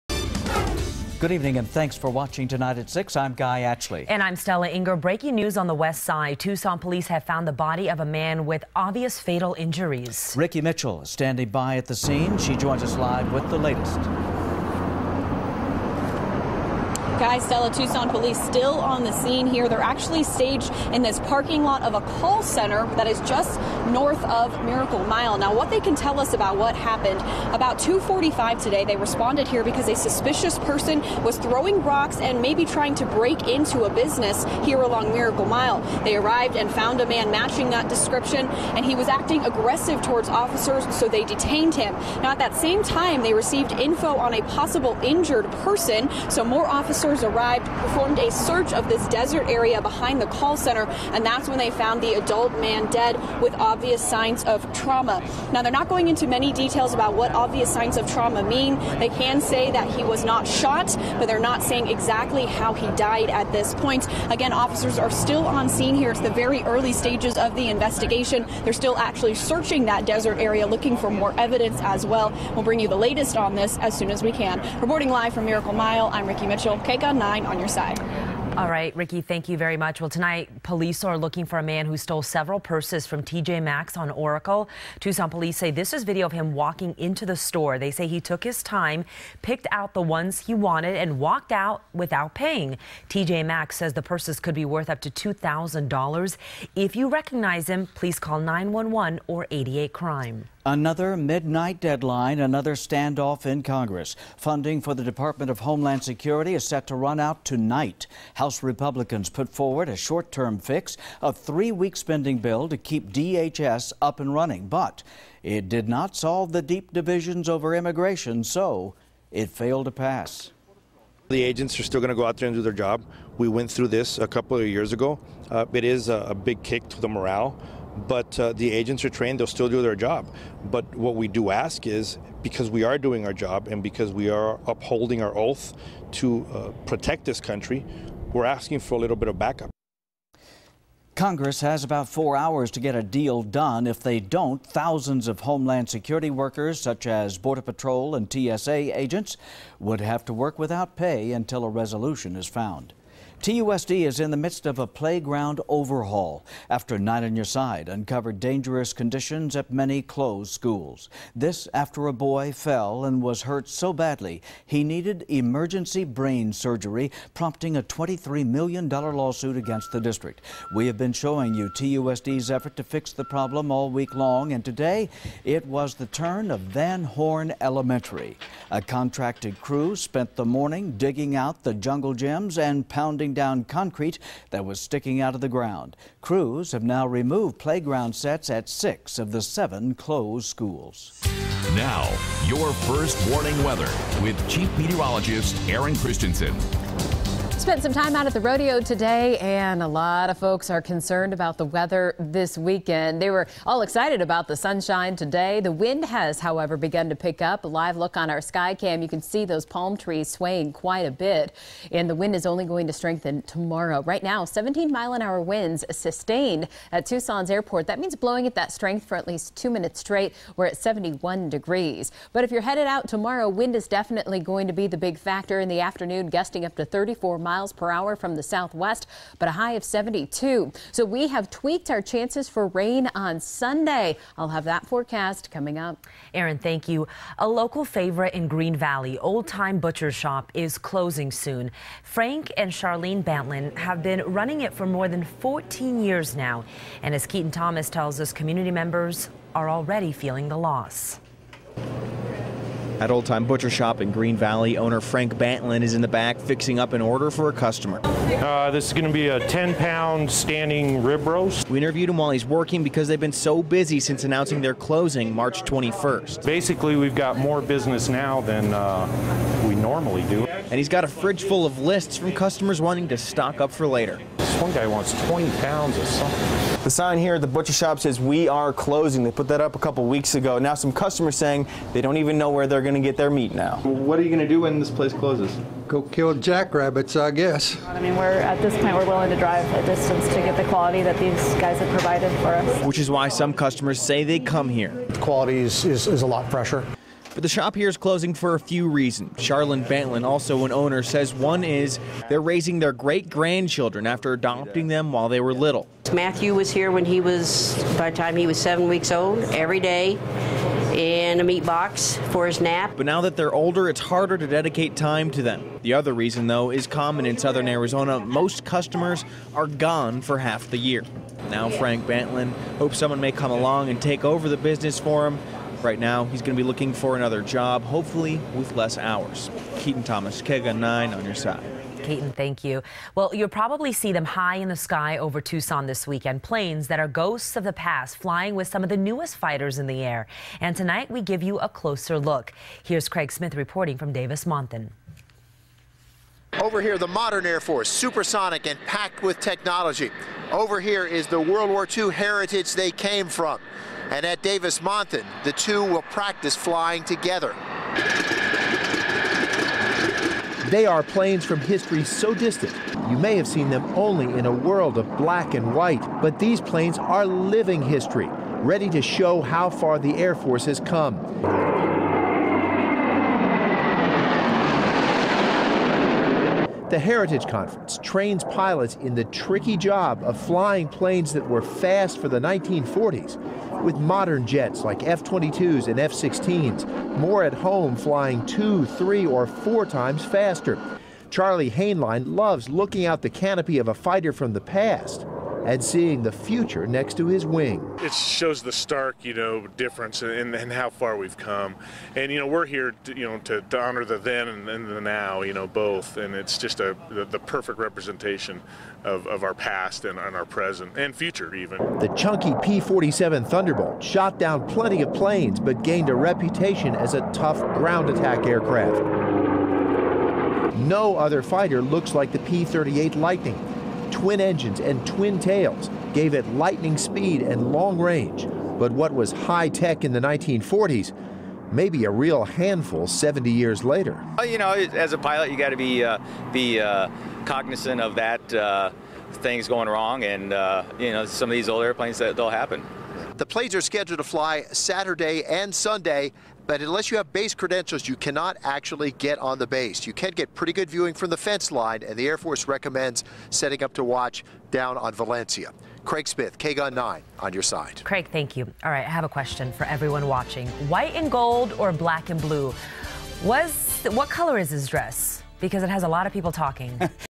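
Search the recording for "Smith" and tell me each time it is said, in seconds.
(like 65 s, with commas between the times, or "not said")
343 s, 456 s.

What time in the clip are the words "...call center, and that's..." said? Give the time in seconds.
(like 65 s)
50 s.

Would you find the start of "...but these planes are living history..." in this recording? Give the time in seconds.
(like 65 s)
366 s.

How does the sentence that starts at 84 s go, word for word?
Tucson police say this is video of him walking into the store.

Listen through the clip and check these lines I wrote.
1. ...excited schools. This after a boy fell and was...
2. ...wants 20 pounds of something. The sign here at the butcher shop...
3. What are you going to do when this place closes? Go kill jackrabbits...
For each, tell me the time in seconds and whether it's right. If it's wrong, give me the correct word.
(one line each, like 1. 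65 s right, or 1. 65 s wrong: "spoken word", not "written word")
1. 160 s wrong: "closed", not "excited"
2. 274 s right
3. 283 s right.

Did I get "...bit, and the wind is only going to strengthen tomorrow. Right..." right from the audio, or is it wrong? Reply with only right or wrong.
right.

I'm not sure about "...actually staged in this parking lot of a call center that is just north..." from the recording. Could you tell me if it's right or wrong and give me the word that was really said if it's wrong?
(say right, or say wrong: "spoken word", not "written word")
right.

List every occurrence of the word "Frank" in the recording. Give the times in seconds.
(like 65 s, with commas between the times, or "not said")
242 s, 255 s, 321 s.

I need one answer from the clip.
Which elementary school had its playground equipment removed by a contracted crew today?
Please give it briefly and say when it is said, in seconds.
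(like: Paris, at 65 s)
Van Horne Elementary, at 176 s.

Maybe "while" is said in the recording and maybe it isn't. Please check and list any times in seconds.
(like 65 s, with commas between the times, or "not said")
262 s, 305 s.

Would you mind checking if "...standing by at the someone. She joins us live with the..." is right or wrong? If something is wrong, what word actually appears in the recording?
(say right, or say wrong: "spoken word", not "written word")
wrong: "scene", not "someone".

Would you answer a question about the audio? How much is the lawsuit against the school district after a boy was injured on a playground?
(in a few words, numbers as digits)
$23 million.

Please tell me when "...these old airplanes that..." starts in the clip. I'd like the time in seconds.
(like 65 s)
441 s.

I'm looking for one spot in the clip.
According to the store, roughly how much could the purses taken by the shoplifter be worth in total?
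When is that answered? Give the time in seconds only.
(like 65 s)
95 s.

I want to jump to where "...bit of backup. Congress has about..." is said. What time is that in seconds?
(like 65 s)
139 s.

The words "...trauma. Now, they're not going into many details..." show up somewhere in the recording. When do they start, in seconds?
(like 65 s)
54 s.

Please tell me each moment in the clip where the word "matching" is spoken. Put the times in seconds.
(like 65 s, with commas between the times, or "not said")
37 s.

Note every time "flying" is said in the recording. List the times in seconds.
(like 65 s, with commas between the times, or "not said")
338 s, 356 s, 380 s, 387 s.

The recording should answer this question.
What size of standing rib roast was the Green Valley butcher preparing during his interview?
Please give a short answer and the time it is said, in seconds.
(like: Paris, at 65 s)
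10 pound, at 259 s.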